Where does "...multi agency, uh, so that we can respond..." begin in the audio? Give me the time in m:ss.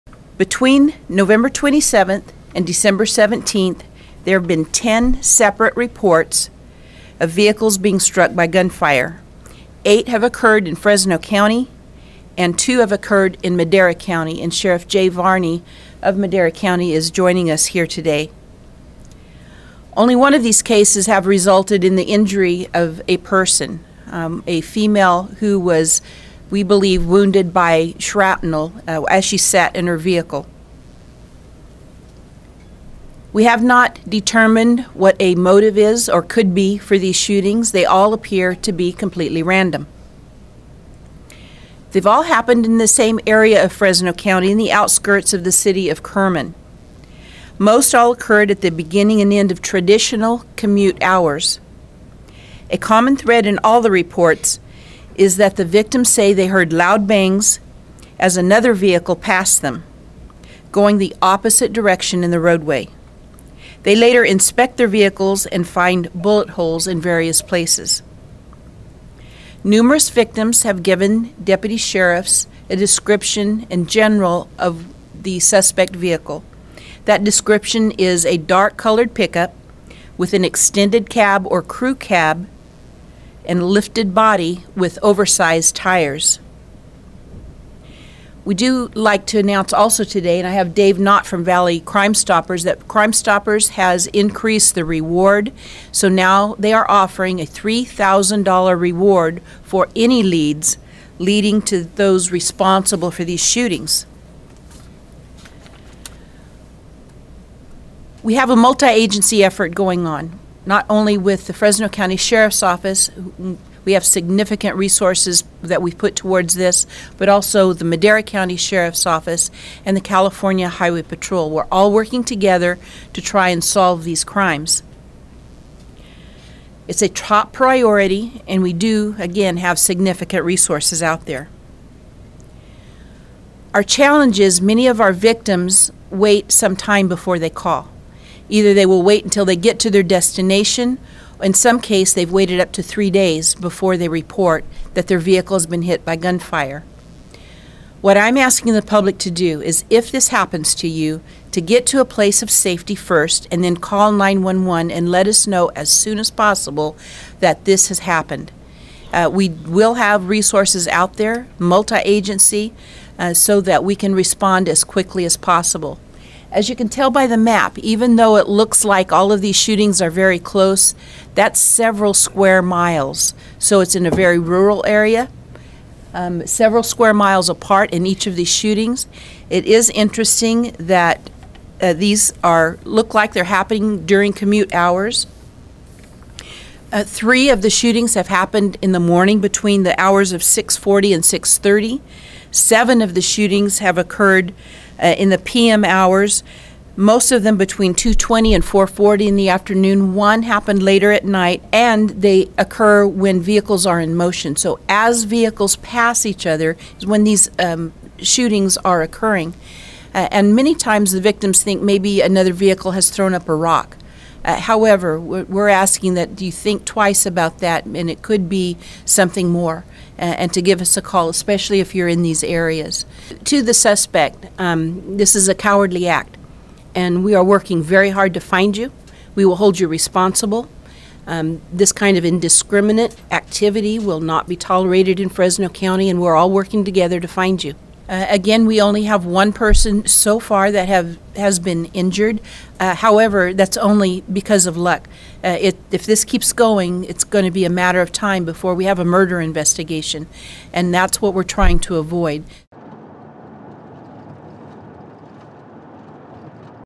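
2:41.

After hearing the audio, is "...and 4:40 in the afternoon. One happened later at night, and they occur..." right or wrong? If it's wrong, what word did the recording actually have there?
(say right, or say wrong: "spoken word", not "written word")
right.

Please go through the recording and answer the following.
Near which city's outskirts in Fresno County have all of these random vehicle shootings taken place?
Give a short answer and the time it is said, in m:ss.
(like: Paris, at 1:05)
Kerman, at 0:46.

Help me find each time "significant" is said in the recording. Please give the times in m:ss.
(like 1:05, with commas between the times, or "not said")
1:54, 2:09.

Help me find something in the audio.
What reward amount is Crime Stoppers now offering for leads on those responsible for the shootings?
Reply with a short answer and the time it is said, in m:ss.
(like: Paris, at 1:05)
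$3,000, at 1:37.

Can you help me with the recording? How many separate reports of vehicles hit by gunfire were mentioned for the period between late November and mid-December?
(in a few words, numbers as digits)
10.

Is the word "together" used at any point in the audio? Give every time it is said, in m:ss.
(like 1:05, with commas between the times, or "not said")
2:02, 3:56.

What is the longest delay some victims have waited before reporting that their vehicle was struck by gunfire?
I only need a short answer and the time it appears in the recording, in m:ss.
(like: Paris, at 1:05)
3 days, at 2:22.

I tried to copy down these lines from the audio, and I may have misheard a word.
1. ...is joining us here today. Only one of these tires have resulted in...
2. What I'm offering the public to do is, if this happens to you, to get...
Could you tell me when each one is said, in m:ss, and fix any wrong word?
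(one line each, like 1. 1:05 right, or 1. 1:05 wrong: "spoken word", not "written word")
1. 0:16 wrong: "cases", not "tires"
2. 2:28 wrong: "asking", not "offering".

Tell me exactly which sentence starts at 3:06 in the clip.
Uh, three of the shootings have happened in the morning between the hours of 6:40 and 6:30.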